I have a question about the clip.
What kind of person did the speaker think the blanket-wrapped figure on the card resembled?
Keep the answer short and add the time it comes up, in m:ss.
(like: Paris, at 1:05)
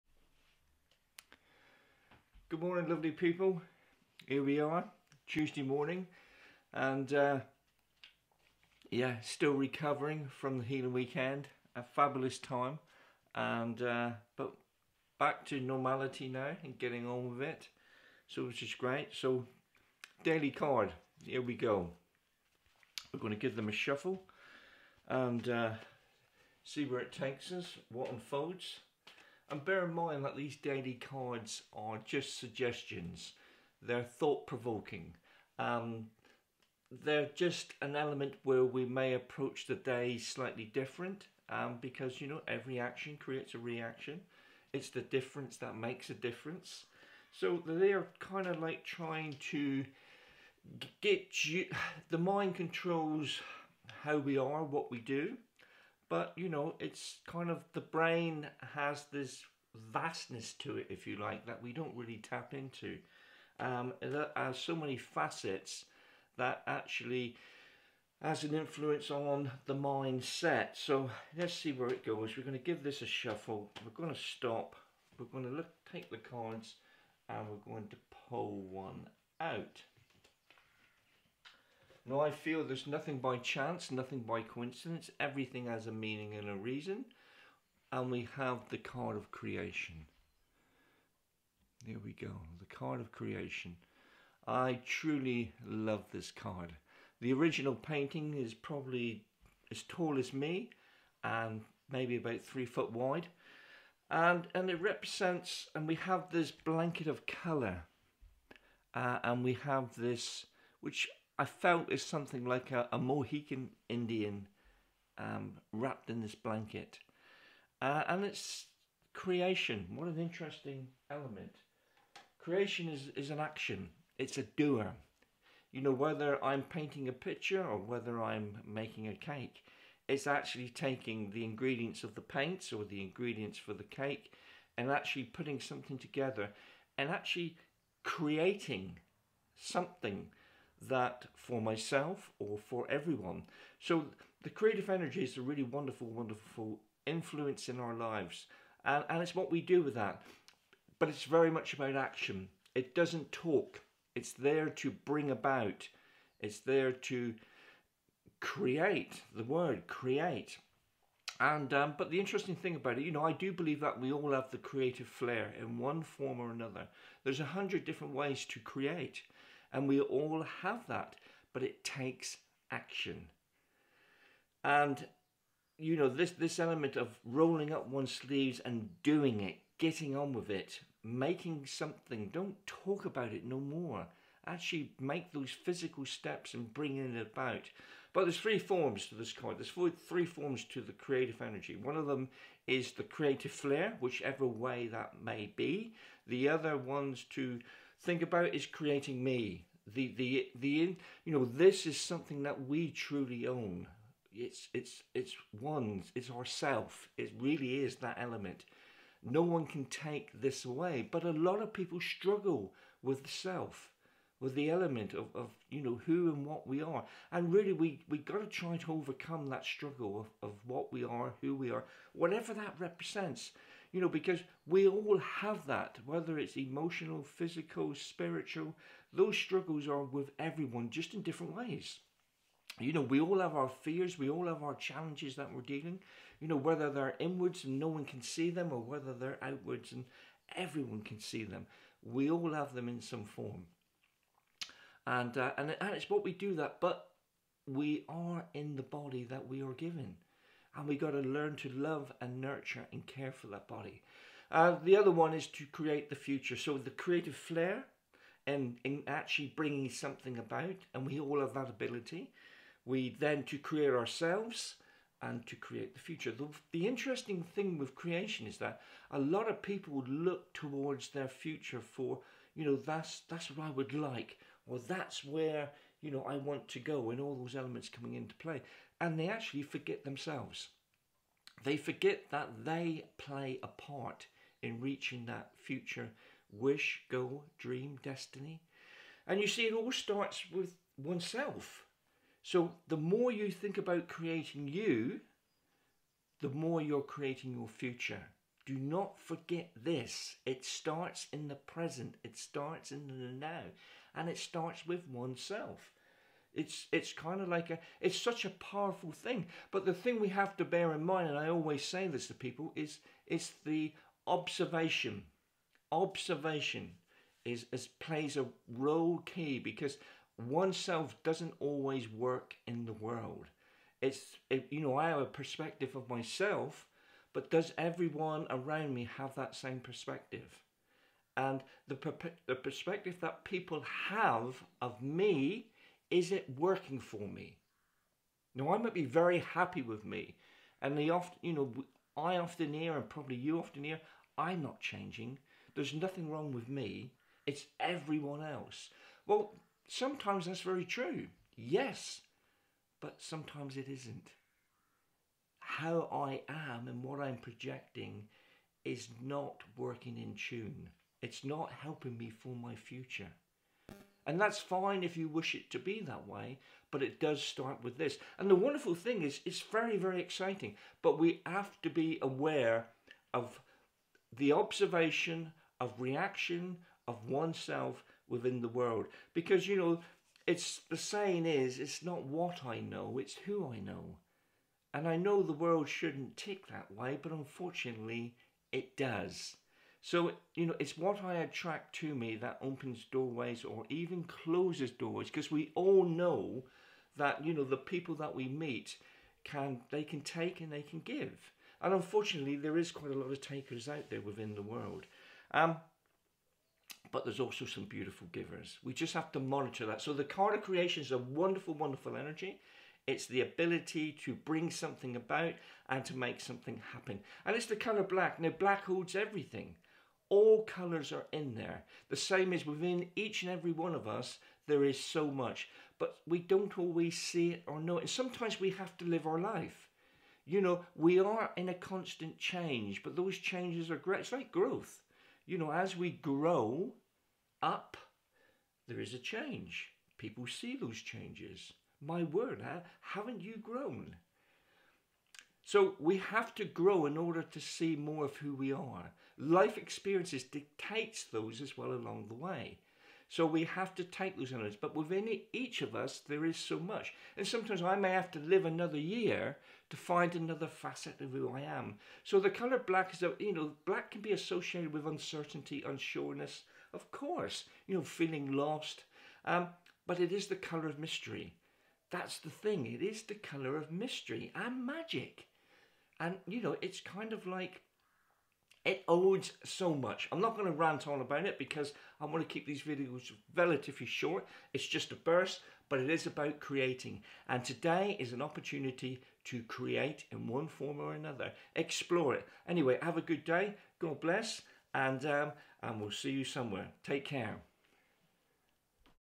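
Mohican Indian, at 1:52.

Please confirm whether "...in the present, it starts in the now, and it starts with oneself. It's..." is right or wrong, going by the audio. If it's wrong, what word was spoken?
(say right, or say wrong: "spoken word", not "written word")
right.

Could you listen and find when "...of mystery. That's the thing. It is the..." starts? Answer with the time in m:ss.
7:50.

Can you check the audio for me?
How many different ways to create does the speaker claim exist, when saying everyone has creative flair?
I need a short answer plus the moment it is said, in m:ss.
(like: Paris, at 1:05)
100, at 2:47.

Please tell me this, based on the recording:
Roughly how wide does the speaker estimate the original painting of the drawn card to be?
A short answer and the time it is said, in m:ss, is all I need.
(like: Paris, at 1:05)
3 feet, at 1:42.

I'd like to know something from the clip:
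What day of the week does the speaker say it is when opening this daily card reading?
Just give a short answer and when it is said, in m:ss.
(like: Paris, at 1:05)
Tuesday, at 0:05.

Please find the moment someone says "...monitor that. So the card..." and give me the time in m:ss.
6:49.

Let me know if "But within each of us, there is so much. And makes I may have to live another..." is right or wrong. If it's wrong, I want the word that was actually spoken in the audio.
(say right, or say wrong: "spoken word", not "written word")
wrong: "sometimes", not "makes".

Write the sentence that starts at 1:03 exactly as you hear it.
Um, that has so many facets that actually has an influence on the mindset.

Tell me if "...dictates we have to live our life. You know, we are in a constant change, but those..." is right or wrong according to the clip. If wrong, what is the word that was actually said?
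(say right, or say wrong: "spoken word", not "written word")
wrong: "sometimes", not "dictates".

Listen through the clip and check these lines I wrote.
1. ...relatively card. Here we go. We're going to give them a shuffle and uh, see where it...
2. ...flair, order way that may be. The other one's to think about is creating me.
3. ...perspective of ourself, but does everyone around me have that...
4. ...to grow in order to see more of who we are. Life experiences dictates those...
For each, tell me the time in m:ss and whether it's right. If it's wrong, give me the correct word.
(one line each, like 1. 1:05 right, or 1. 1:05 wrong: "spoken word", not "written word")
1. 0:20 wrong: "daily", not "relatively"
2. 3:13 wrong: "whichever", not "order"
3. 5:25 wrong: "myself", not "ourself"
4. 7:26 right.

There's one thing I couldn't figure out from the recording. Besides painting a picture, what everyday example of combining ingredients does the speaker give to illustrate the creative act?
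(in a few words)
making a cake.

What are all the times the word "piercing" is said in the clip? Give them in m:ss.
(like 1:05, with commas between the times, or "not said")
not said.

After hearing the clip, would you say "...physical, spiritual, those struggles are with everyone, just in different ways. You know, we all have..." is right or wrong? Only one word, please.
right.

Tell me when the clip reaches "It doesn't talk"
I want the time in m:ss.
2:32.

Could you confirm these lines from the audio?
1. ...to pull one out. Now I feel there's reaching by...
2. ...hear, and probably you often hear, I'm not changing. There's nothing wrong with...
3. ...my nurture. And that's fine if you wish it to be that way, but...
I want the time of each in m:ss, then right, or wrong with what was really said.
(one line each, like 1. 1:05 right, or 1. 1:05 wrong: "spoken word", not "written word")
1. 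1:17 wrong: "nothing", not "reaching"
2. 5:42 right
3. 6:02 wrong: "future", not "nurture".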